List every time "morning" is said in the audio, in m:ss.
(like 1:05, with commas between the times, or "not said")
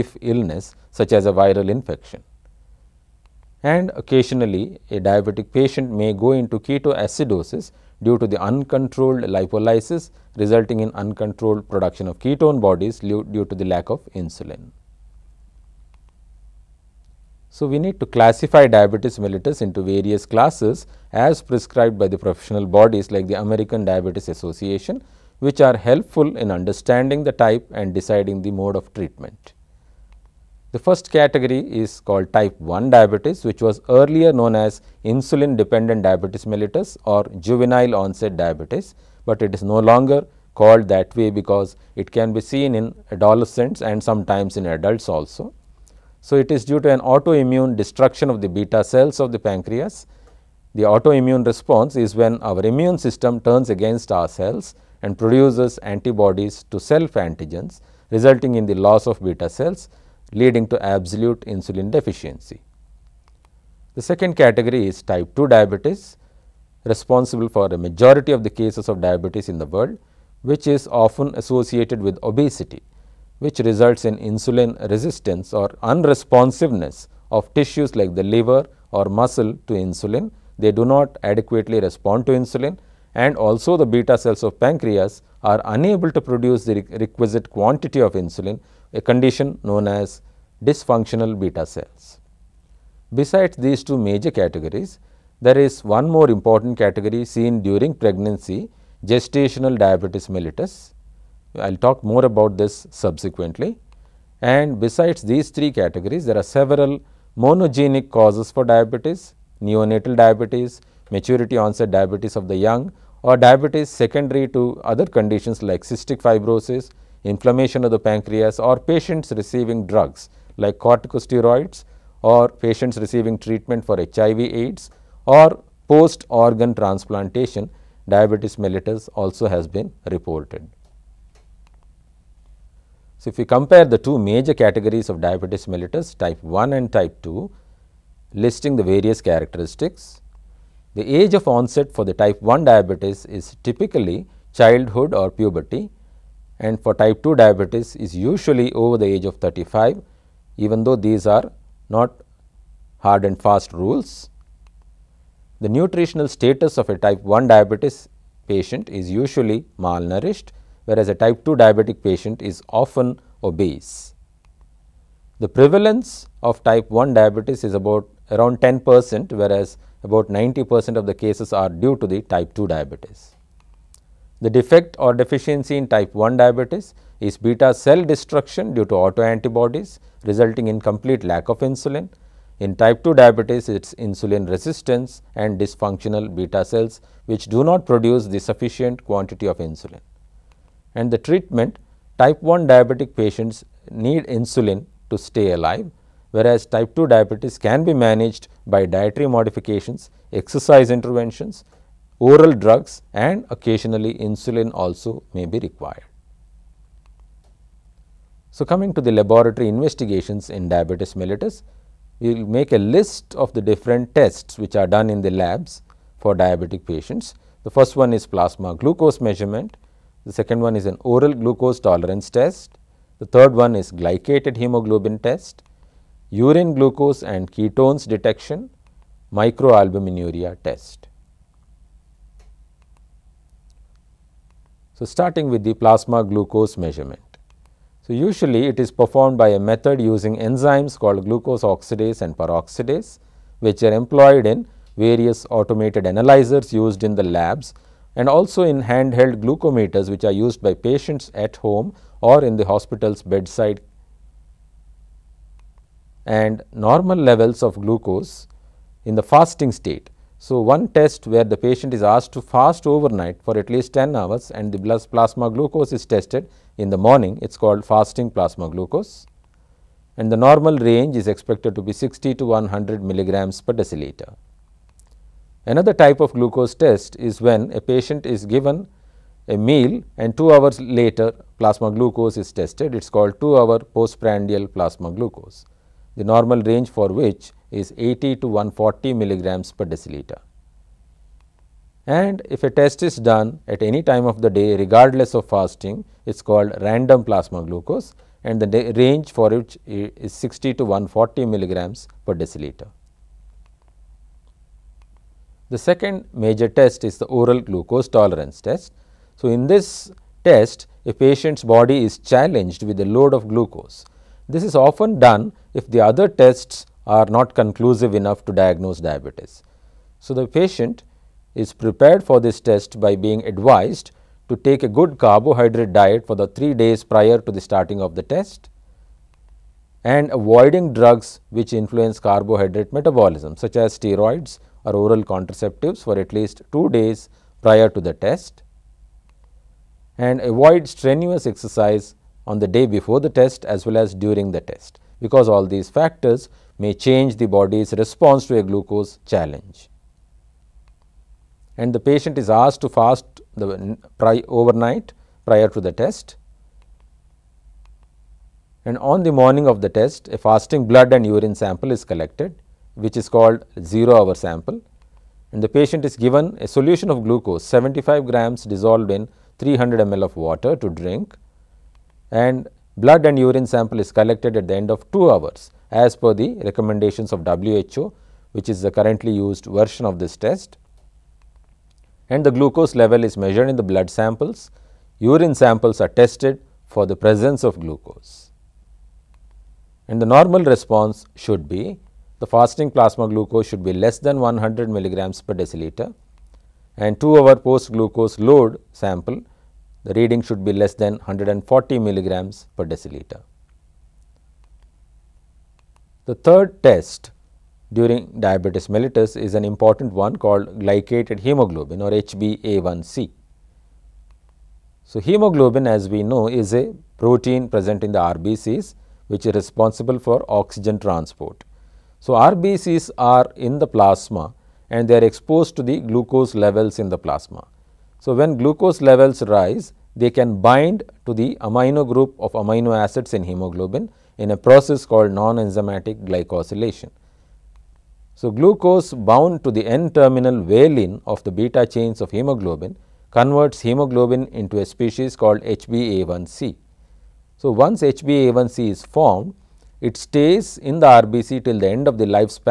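4:26, 5:59.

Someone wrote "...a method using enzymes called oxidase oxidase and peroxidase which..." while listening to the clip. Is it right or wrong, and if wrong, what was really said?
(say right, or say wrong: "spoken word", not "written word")
wrong: "glucose", not "oxidase".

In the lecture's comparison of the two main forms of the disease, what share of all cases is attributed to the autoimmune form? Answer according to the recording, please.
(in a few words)
10 percent.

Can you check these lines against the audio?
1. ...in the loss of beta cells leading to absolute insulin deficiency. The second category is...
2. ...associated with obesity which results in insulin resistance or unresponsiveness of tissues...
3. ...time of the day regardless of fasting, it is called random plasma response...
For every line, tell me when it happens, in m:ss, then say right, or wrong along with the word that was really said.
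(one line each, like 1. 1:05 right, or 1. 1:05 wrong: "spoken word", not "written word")
1. 0:58 right
2. 1:11 right
3. 4:54 wrong: "glucose", not "response".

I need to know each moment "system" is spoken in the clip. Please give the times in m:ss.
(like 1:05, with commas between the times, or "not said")
0:52.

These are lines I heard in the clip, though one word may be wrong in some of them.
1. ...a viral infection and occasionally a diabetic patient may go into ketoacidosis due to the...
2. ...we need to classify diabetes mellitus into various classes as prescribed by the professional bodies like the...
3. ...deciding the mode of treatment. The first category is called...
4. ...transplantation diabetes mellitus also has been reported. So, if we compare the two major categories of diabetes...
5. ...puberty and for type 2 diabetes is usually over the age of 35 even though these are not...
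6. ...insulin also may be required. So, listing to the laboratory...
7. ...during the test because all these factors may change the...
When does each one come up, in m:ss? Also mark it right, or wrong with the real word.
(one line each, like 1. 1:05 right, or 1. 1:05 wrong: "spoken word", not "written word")
1. 0:01 right
2. 0:17 right
3. 0:27 right
4. 2:06 right
5. 2:25 right
6. 3:24 wrong: "coming", not "listing"
7. 5:44 right.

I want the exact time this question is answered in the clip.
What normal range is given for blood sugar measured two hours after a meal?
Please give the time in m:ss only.
4:47.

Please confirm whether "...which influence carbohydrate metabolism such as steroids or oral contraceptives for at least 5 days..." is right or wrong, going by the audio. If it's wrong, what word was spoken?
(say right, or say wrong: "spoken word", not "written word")
wrong: "2", not "5".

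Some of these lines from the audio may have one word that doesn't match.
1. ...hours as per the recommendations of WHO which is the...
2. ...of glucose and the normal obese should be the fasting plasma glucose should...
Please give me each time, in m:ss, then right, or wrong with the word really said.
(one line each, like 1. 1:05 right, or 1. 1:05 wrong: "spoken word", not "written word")
1. 6:15 right
2. 6:27 wrong: "response", not "obese".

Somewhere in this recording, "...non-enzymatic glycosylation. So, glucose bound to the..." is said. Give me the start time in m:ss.
7:15.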